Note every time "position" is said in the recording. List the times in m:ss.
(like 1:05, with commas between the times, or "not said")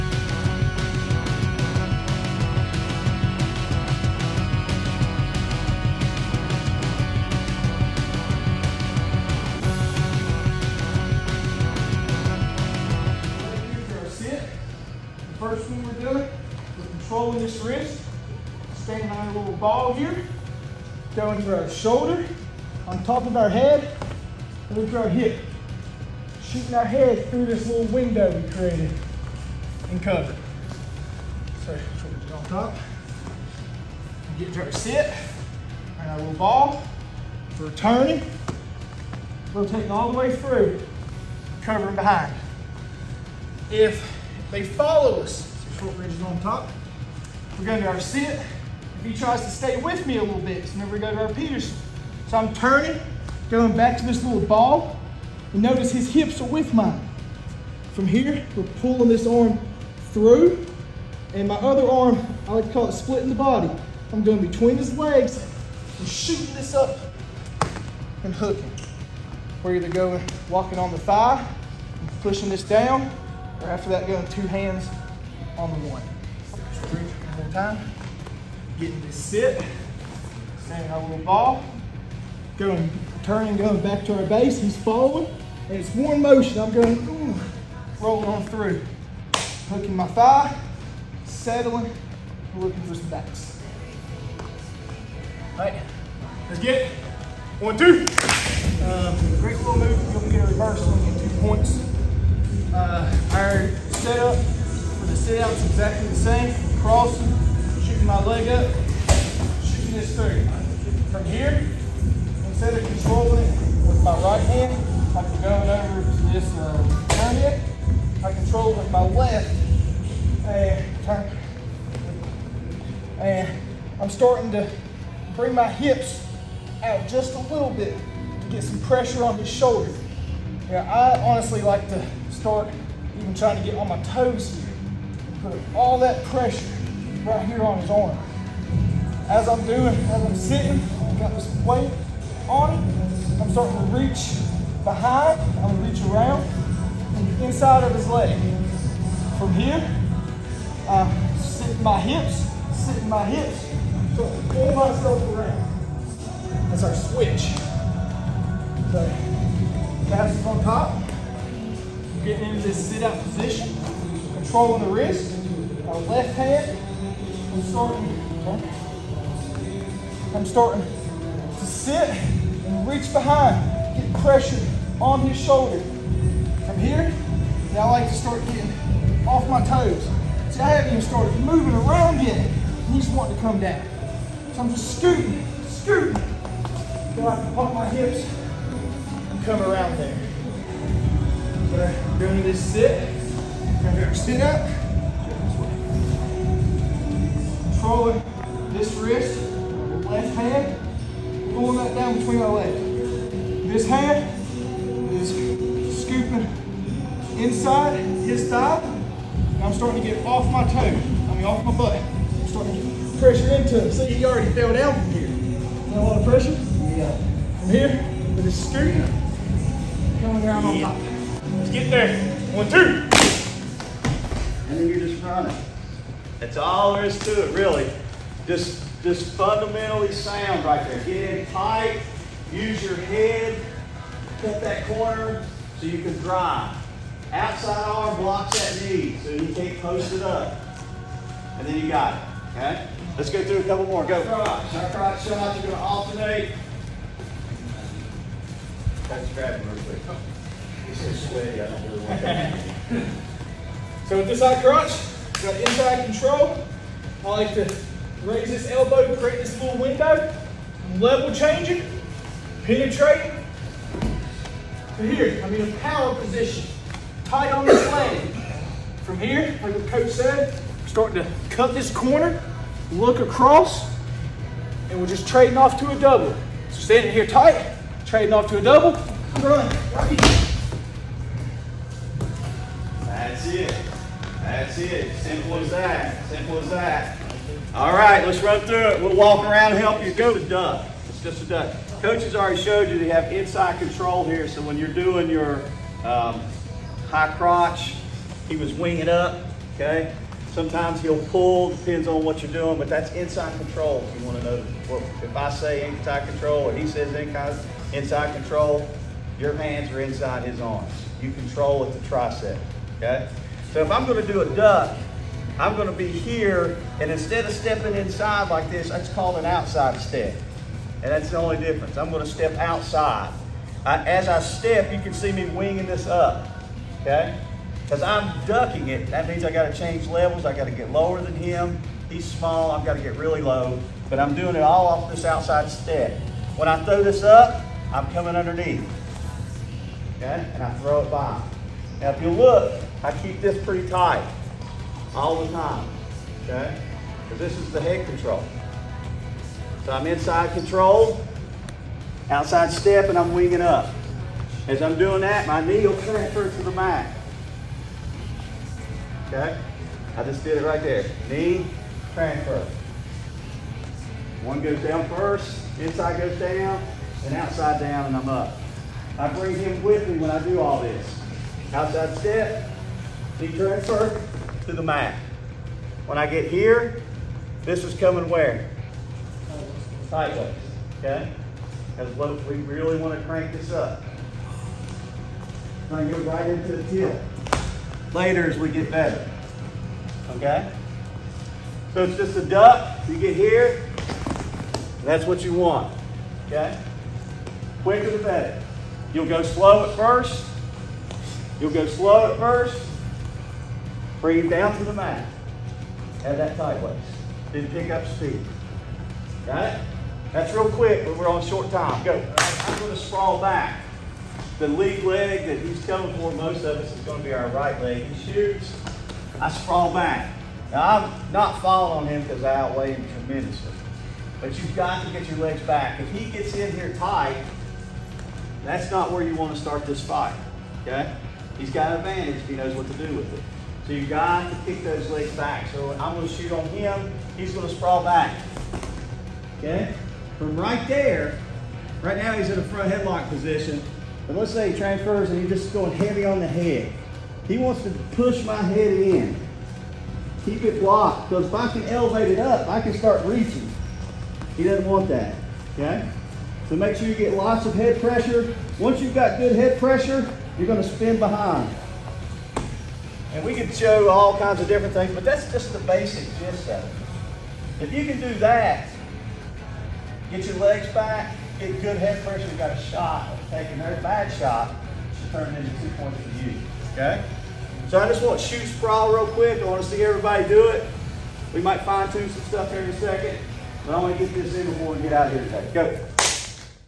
2:43, 4:26, 7:23.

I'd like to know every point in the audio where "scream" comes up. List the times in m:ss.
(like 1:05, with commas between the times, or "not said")
not said.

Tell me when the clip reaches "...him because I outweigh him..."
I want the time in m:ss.
7:02.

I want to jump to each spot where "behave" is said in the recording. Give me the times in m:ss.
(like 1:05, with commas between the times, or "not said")
not said.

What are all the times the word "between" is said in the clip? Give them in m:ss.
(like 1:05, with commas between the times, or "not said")
1:04, 3:22.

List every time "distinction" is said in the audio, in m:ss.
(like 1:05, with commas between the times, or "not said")
not said.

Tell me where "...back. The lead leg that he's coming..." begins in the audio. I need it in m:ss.
6:53.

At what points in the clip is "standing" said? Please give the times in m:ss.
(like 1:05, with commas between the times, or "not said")
1:20, 4:36.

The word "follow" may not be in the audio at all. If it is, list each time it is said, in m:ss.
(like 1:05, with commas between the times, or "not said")
0:44.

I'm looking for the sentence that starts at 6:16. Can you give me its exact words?
When I get here, this is coming where?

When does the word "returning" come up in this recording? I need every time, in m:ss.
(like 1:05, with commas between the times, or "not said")
0:37.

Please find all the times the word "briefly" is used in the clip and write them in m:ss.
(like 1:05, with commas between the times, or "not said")
not said.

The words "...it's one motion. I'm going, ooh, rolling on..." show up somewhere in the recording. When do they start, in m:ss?
1:25.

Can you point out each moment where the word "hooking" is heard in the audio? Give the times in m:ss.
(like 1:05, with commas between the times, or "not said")
1:08, 1:29.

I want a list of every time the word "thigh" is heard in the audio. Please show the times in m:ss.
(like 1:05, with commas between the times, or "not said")
1:10, 1:30, 3:28.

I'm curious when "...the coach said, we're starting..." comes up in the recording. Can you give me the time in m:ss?
4:29.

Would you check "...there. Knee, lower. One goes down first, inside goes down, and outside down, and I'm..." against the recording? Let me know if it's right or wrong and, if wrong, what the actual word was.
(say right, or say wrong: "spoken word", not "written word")
wrong: "transfer", not "lower".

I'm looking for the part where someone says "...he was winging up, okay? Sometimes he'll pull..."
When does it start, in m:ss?
4:58.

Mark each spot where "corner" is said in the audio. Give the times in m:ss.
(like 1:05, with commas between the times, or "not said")
3:54, 4:31.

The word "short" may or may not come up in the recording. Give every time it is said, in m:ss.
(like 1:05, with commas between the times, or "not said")
0:45, 6:51.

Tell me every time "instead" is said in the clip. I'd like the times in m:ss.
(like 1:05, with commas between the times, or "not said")
1:52, 5:17.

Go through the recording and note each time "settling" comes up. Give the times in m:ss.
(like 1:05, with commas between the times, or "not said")
1:31.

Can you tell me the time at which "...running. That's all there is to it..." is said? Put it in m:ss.
3:45.